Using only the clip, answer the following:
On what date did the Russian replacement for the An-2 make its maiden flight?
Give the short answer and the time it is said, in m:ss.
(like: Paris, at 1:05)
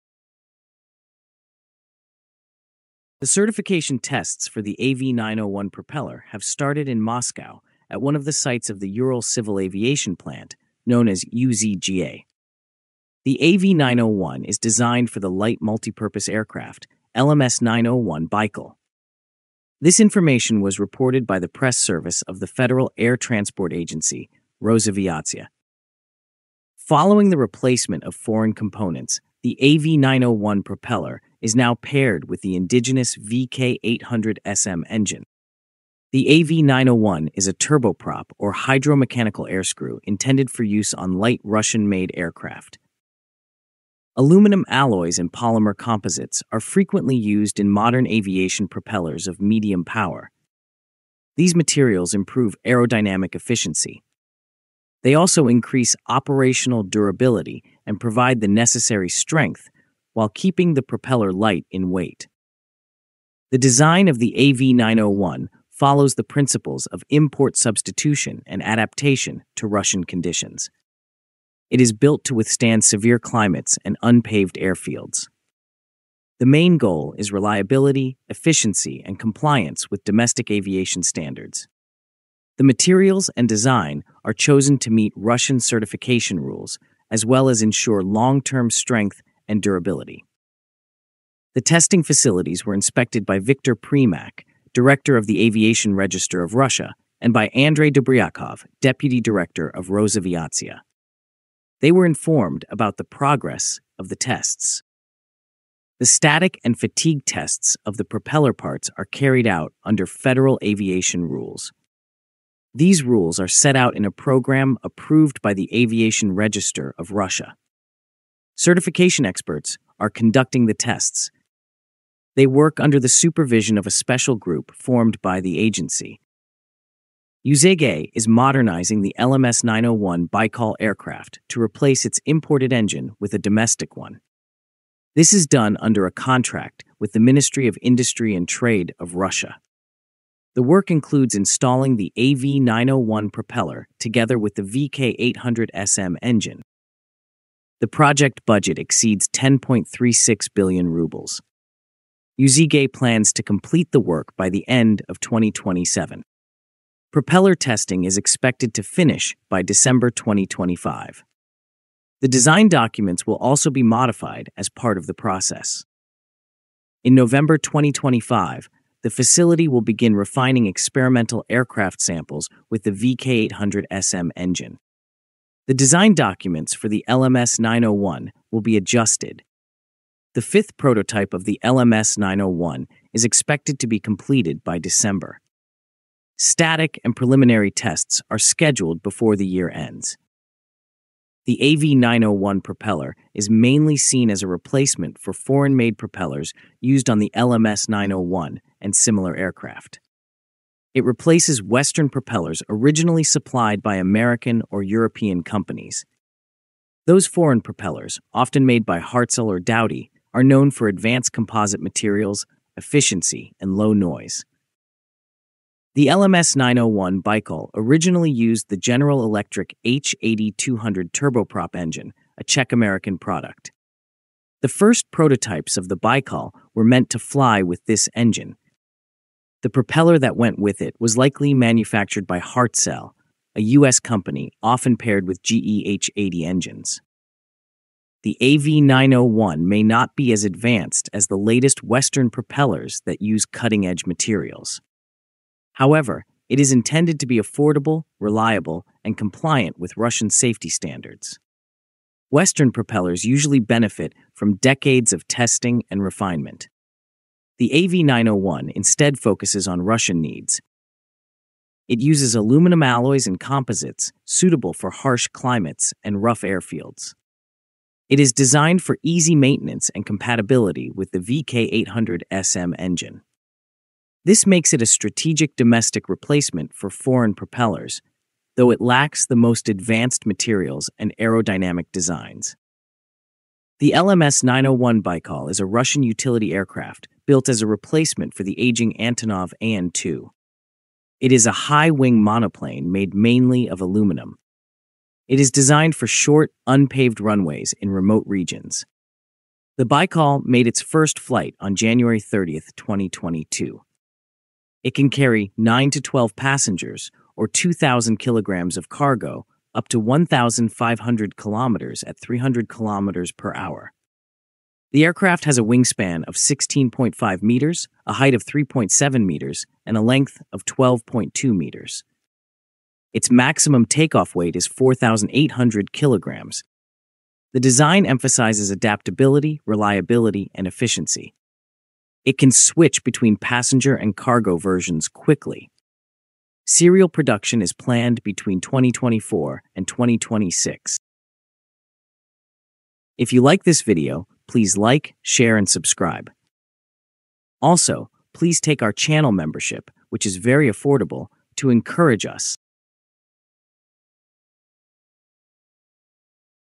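January 30, 2022, at 5:01.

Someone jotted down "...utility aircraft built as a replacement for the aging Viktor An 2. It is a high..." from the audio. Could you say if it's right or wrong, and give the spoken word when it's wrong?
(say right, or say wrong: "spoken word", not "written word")
wrong: "Antonov", not "Viktor".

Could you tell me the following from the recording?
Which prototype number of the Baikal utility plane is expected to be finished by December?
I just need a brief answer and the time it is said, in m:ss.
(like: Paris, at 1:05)
fifth, at 3:00.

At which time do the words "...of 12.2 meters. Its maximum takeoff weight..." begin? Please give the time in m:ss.
5:20.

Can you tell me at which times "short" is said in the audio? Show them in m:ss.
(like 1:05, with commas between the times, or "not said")
4:56.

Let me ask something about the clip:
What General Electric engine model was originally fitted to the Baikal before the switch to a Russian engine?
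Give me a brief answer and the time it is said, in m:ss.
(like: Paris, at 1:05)
H80-200, at 3:39.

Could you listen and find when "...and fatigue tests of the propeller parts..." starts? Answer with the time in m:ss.
1:46.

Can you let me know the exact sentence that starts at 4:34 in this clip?
This makes it a strategic domestic replacement for foreign propellers, though it lacks the most advanced materials and aerodynamic designs.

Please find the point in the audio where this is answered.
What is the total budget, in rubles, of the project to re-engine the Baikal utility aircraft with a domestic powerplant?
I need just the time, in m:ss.
2:29.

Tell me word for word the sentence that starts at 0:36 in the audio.
The AV901 is a turboprop or hydromechanical air screw intended for use on light Russian made aircraft.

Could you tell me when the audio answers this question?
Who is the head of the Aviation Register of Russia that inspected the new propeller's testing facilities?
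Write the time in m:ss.
1:33.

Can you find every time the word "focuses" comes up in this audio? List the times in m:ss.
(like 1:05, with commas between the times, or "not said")
4:19.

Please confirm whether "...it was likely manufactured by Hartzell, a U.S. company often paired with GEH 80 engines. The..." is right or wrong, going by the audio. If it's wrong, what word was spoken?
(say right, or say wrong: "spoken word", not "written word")
right.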